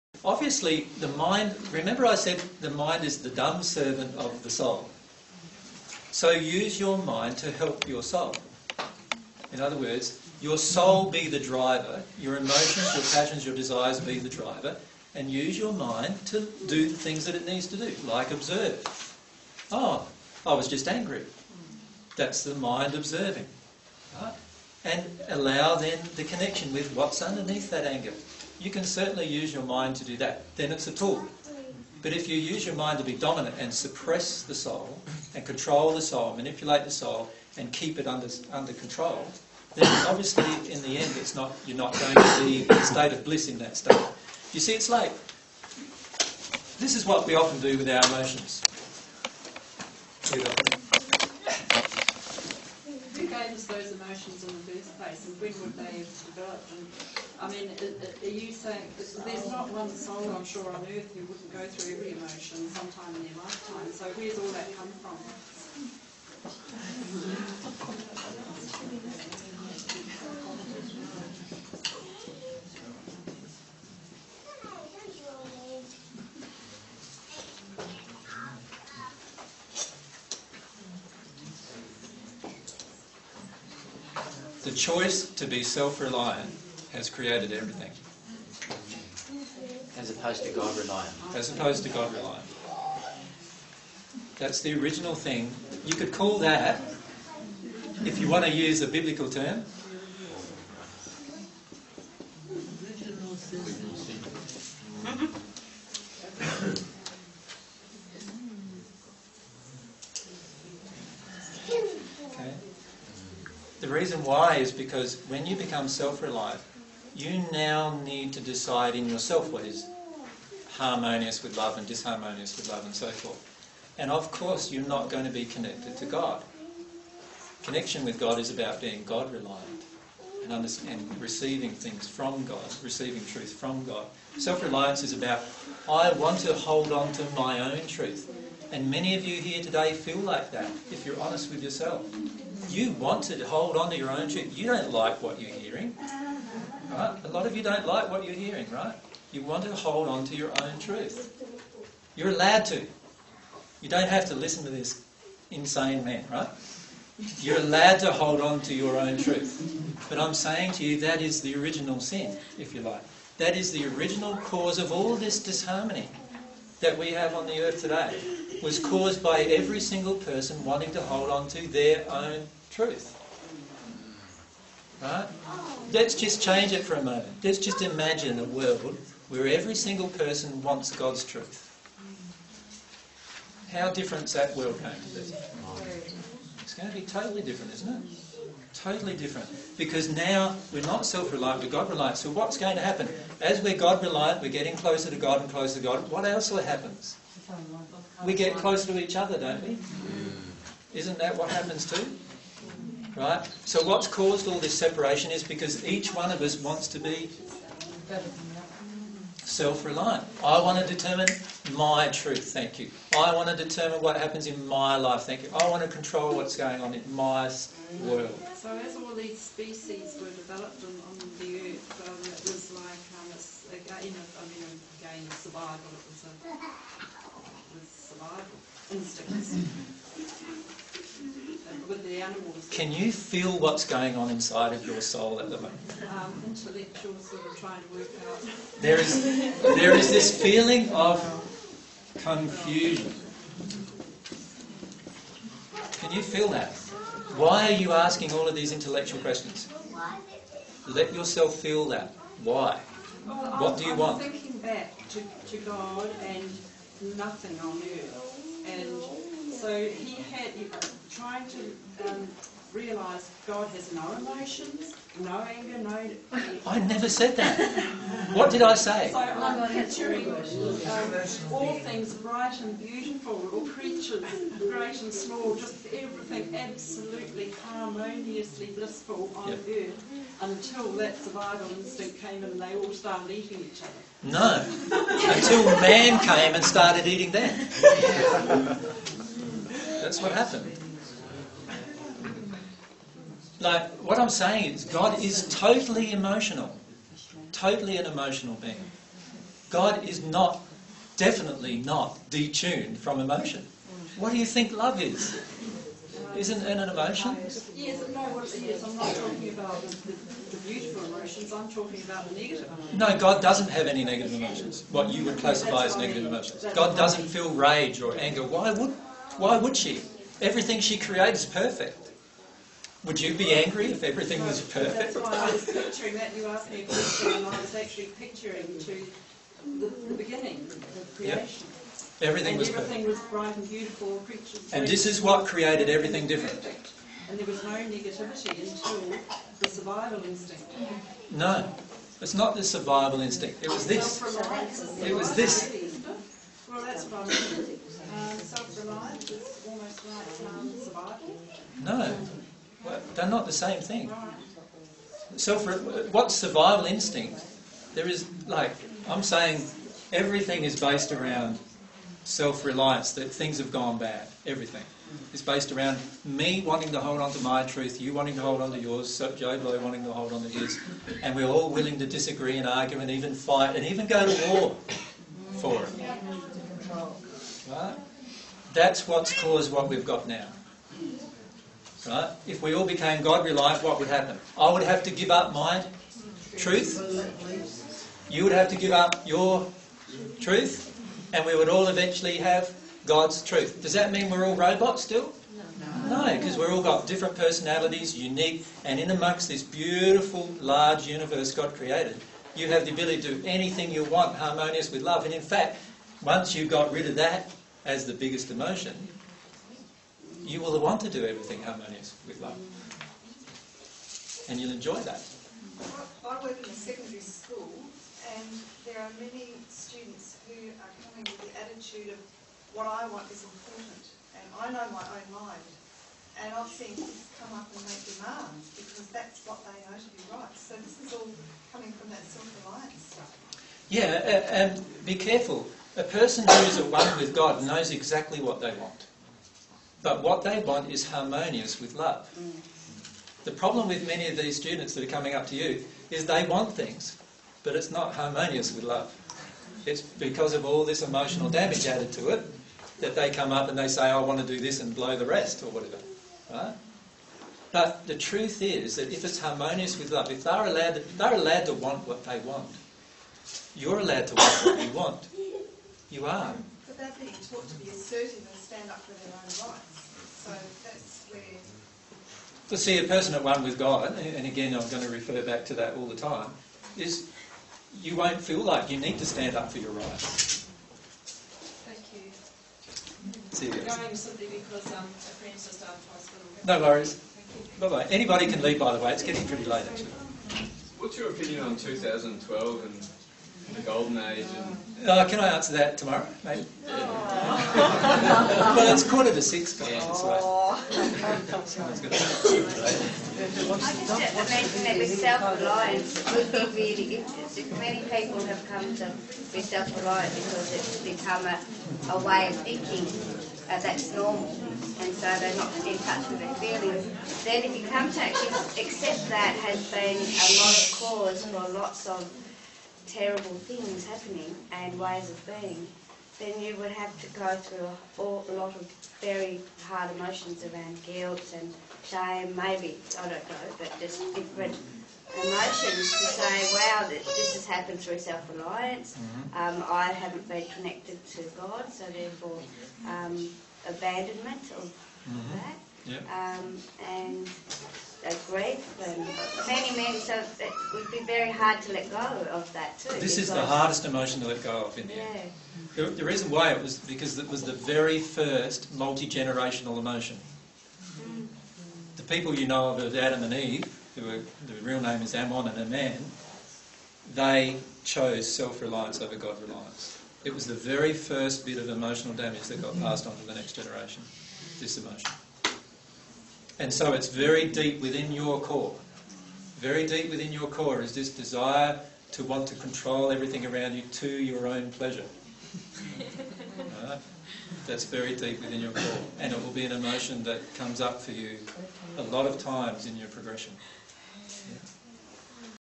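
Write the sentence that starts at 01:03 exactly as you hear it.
So where's all that come from?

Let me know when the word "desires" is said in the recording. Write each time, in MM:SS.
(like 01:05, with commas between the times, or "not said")
00:13, 09:41.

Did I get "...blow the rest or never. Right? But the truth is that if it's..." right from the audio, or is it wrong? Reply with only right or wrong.
wrong.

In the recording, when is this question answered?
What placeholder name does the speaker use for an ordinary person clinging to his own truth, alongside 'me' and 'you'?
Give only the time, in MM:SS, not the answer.
06:09.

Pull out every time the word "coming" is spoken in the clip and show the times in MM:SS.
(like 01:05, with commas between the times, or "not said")
07:01, 07:11, 07:25.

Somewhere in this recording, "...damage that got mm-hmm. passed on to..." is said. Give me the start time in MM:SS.
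09:32.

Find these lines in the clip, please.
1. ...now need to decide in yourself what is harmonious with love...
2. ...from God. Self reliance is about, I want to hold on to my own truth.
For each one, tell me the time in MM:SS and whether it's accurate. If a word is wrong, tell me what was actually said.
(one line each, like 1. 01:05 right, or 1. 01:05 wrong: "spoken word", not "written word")
1. 01:57 right
2. 02:13 right.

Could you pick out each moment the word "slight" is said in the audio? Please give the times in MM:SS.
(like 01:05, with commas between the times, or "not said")
not said.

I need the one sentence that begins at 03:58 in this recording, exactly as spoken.
There is, there is this feeling of confusion.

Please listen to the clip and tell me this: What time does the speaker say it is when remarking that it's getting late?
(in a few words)
quarter to six.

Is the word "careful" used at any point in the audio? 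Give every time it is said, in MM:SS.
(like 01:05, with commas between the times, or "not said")
07:15.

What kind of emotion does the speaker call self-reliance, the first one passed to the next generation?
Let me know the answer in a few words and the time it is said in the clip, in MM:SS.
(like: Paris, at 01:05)
multi-generational emotion, at 09:18.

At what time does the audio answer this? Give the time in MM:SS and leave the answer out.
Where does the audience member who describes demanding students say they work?
06:56.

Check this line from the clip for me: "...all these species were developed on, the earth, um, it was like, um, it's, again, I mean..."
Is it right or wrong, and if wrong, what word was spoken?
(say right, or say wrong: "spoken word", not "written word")
right.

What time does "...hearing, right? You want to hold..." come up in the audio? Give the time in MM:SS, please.
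02:28.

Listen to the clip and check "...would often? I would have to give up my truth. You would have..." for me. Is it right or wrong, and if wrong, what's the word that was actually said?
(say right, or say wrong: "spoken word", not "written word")
wrong: "happen", not "often".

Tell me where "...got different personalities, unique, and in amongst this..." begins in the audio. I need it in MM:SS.
06:36.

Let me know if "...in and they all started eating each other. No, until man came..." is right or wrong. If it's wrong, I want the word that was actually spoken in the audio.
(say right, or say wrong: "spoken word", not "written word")
right.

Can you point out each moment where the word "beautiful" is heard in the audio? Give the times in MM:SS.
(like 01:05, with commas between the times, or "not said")
04:32, 05:10, 05:33, 06:39.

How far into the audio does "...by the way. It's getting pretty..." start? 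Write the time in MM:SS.
08:08.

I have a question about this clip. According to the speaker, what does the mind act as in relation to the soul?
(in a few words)
the dumb servant.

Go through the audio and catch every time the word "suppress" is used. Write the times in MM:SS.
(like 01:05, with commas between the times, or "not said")
00:33.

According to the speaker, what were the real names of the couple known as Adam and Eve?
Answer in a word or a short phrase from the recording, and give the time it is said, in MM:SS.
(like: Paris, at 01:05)
Ammon and Aman, at 09:25.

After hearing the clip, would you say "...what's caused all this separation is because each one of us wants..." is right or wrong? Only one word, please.
right.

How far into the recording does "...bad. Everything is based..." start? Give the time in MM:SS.
06:03.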